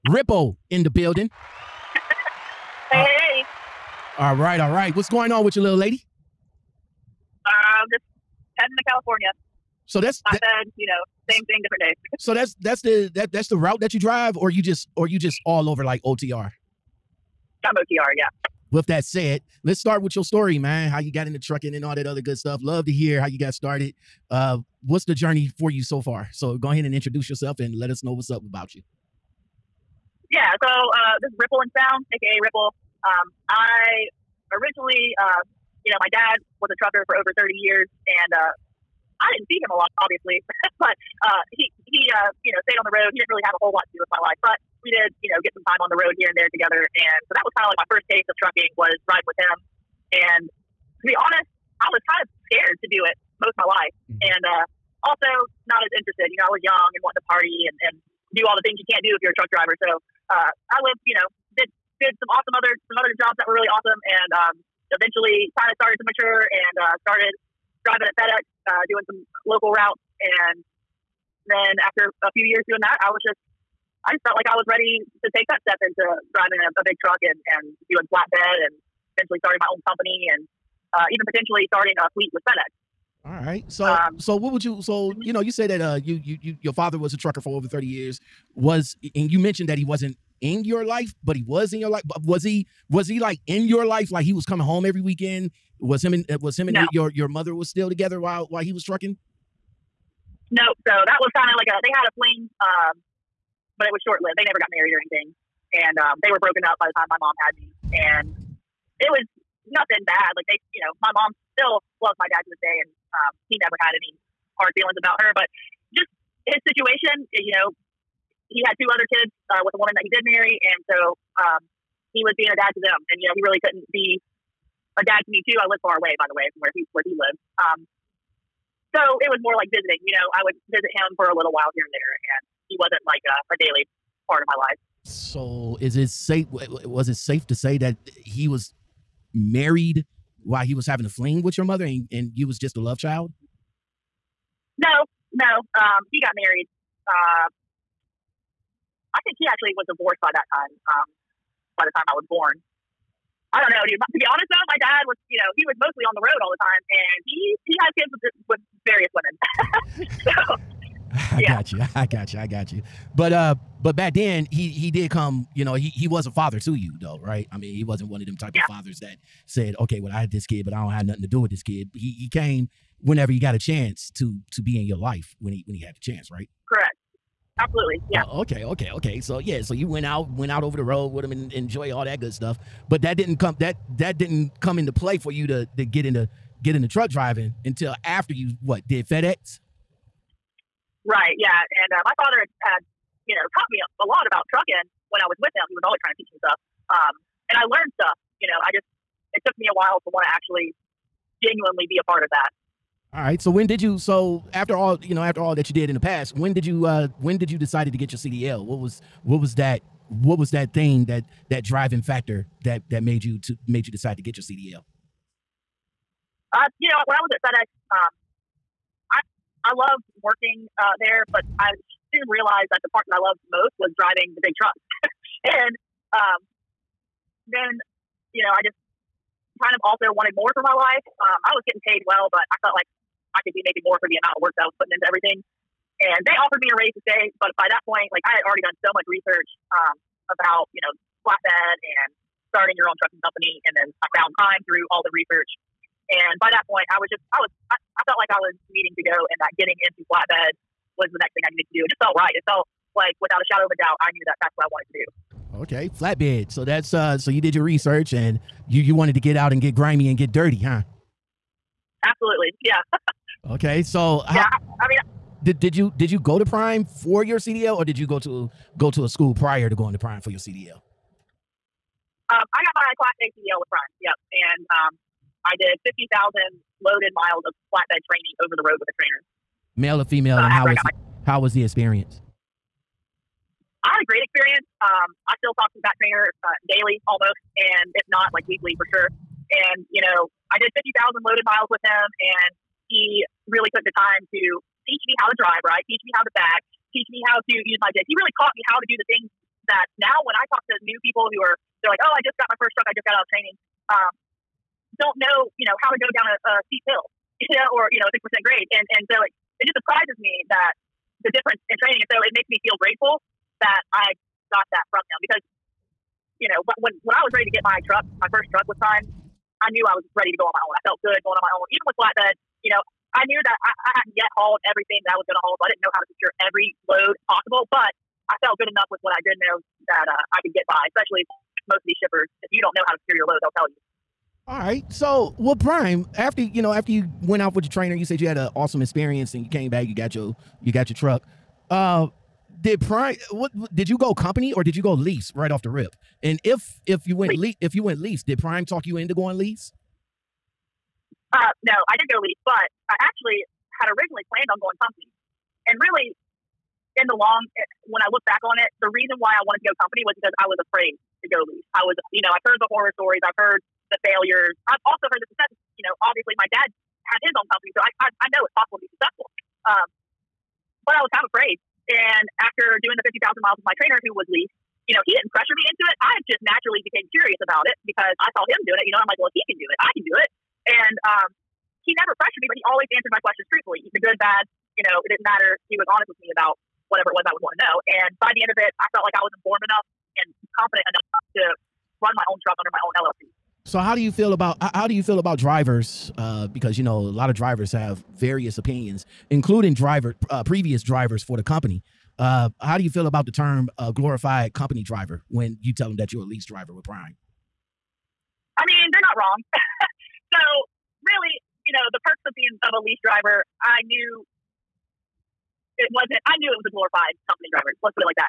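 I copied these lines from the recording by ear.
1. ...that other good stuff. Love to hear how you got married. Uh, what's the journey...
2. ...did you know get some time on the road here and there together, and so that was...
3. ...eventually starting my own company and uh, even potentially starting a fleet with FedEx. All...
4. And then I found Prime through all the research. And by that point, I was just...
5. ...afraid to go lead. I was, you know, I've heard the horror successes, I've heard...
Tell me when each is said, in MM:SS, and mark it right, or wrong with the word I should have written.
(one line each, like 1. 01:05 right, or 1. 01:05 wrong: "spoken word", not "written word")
1. 00:21 wrong: "started", not "married"
2. 00:44 right
3. 01:19 right
4. 04:03 right
5. 06:00 wrong: "stories", not "successes".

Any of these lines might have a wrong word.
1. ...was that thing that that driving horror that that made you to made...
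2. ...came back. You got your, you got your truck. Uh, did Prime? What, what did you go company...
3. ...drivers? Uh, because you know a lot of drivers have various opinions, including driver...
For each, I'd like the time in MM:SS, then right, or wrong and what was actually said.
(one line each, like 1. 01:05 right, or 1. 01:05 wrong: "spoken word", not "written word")
1. 03:30 wrong: "factor", not "horror"
2. 05:39 right
3. 06:35 right.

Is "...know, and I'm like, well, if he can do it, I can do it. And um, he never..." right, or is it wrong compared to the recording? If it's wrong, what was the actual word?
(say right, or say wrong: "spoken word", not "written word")
right.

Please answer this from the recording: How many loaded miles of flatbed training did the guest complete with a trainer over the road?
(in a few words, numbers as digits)
50,000.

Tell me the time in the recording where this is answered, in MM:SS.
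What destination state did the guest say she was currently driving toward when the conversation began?
00:08.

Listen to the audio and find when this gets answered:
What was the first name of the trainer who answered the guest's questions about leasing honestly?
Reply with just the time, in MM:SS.
06:14.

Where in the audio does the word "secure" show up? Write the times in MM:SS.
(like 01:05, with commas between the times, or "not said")
05:26, 05:33.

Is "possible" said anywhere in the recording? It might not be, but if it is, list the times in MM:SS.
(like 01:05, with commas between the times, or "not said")
05:27, 06:08.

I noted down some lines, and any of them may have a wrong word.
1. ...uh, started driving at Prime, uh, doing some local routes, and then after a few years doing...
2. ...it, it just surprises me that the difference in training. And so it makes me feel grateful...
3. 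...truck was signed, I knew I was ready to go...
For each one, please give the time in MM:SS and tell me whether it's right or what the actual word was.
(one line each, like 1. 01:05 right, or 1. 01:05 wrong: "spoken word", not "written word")
1. 01:06 wrong: "FedEx", not "Prime"
2. 05:09 right
3. 05:18 right.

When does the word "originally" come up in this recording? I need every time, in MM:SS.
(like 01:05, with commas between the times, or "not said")
00:34, 05:53.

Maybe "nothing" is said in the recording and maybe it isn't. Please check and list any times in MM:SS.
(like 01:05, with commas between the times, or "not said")
01:49, 02:51.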